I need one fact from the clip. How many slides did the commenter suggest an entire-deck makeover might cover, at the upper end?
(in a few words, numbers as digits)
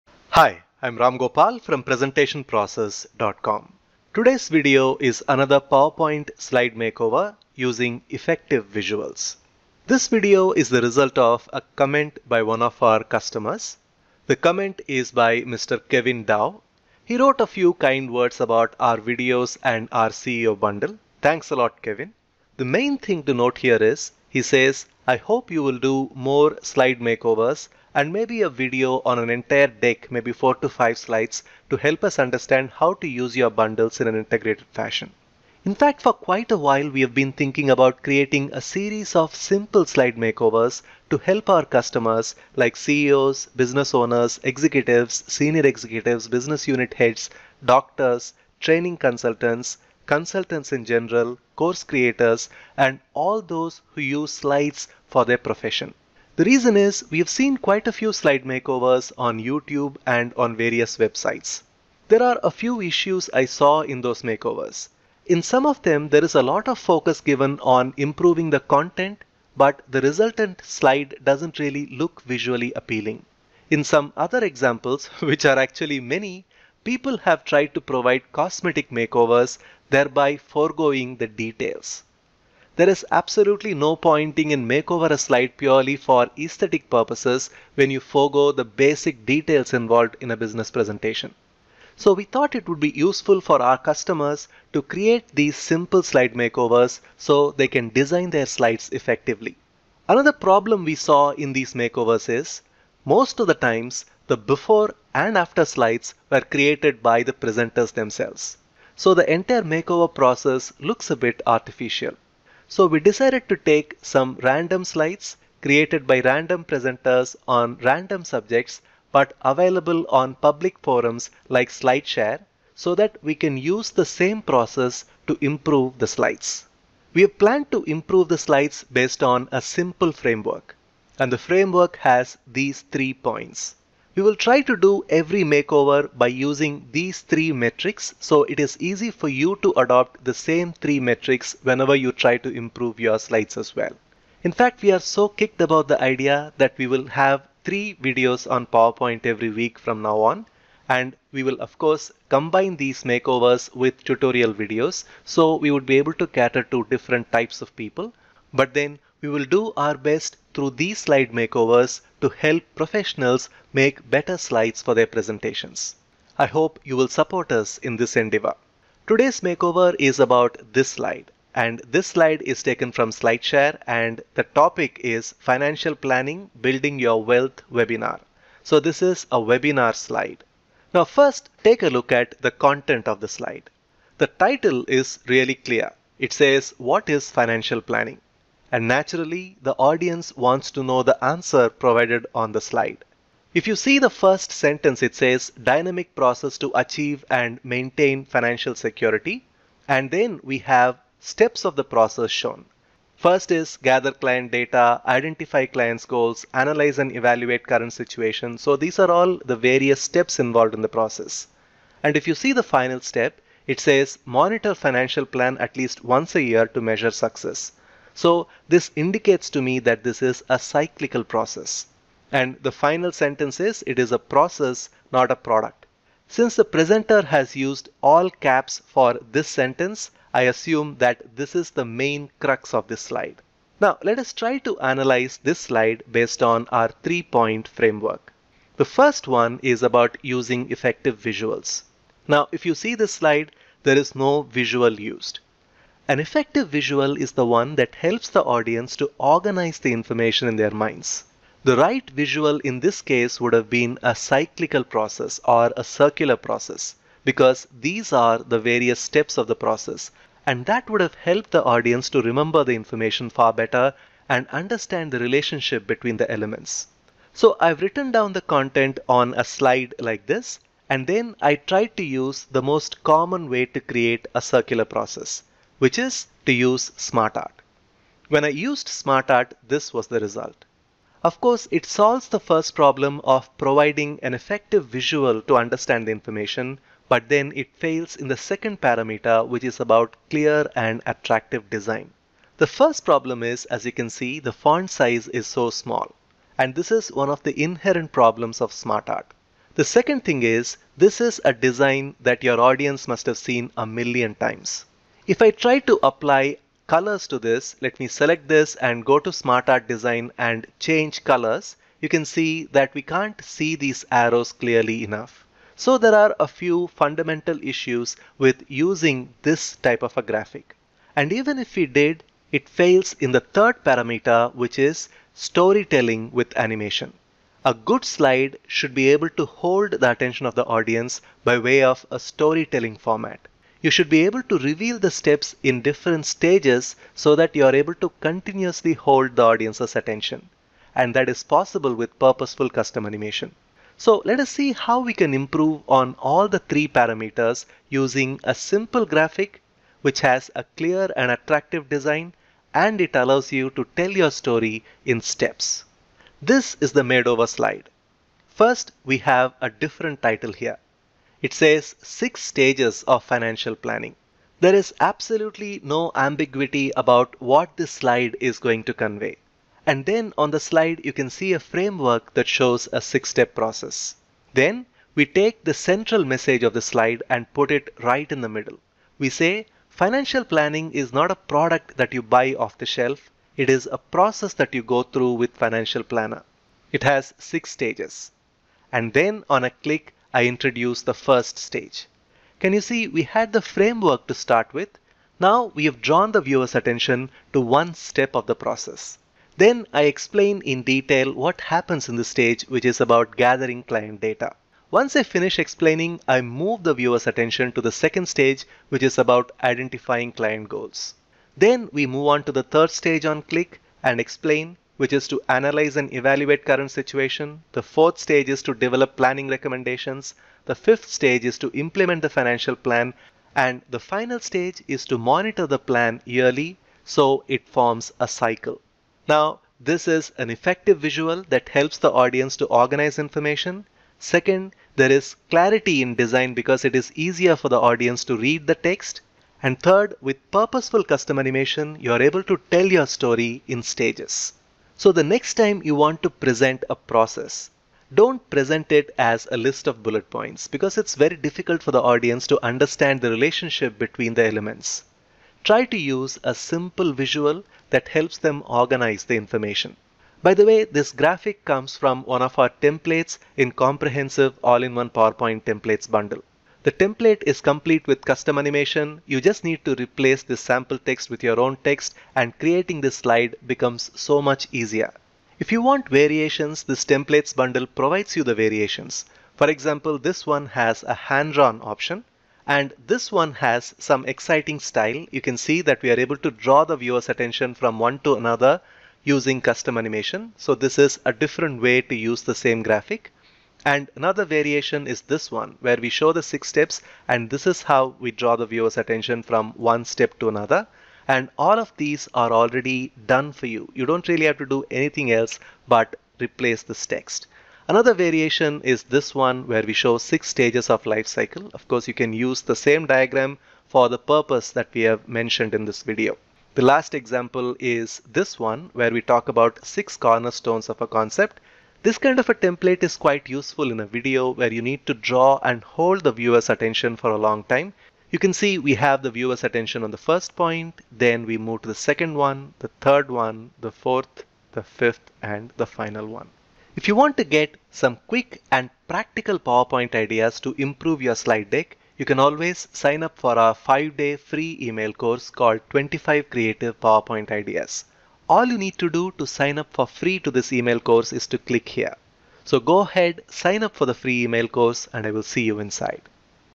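5.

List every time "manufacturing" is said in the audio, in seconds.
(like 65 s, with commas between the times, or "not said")
not said.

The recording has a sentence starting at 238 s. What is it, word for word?
The first one is about using effective visuals.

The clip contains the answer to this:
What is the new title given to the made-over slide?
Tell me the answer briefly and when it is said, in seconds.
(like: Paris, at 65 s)
Six stages of financial planning, at 362 s.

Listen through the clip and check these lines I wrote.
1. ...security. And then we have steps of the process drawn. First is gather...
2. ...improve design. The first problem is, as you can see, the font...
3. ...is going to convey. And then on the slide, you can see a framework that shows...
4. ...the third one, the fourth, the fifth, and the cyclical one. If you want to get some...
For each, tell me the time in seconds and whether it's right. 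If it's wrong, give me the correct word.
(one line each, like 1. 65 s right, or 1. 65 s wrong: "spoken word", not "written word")
1. 198 s wrong: "shown", not "drawn"
2. 291 s wrong: "attractive", not "improve"
3. 368 s right
4. 532 s wrong: "final", not "cyclical".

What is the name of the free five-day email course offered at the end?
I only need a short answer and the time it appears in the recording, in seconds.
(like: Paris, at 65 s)
25 Creative PowerPoint Ideas, at 545 s.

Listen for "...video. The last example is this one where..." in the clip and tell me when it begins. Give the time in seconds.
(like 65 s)
516 s.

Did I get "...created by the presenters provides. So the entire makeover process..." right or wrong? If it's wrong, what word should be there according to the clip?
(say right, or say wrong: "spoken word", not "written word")
wrong: "themselves", not "provides".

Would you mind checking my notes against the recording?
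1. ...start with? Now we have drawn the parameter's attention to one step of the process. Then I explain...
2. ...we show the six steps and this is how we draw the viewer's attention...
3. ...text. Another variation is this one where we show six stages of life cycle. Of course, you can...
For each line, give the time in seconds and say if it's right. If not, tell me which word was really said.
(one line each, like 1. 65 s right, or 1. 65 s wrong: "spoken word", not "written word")
1. 394 s wrong: "viewer", not "parameter"
2. 495 s right
3. 507 s right.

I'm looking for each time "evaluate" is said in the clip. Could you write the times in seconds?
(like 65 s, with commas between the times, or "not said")
207 s, 416 s.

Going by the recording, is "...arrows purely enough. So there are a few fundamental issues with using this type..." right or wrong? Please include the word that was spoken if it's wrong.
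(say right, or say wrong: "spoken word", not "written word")
wrong: "clearly", not "purely".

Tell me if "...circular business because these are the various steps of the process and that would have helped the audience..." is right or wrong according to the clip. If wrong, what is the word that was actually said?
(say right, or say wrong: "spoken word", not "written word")
wrong: "process", not "business".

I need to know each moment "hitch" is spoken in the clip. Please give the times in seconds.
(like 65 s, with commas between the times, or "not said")
not said.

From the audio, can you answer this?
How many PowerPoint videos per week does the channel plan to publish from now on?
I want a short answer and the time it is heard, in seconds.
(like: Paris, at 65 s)
3, at 147 s.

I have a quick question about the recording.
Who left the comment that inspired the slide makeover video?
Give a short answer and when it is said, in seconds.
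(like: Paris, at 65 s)
Kevin Dow, at 15 s.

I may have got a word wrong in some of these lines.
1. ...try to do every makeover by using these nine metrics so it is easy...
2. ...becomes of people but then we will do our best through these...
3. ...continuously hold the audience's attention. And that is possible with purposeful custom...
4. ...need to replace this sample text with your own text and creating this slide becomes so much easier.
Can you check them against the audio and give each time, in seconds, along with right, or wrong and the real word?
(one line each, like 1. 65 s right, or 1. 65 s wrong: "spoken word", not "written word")
1. 134 s wrong: "three", not "nine"
2. 157 s wrong: "types", not "becomes"
3. 338 s right
4. 469 s right.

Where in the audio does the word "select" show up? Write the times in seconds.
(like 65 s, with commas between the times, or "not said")
308 s.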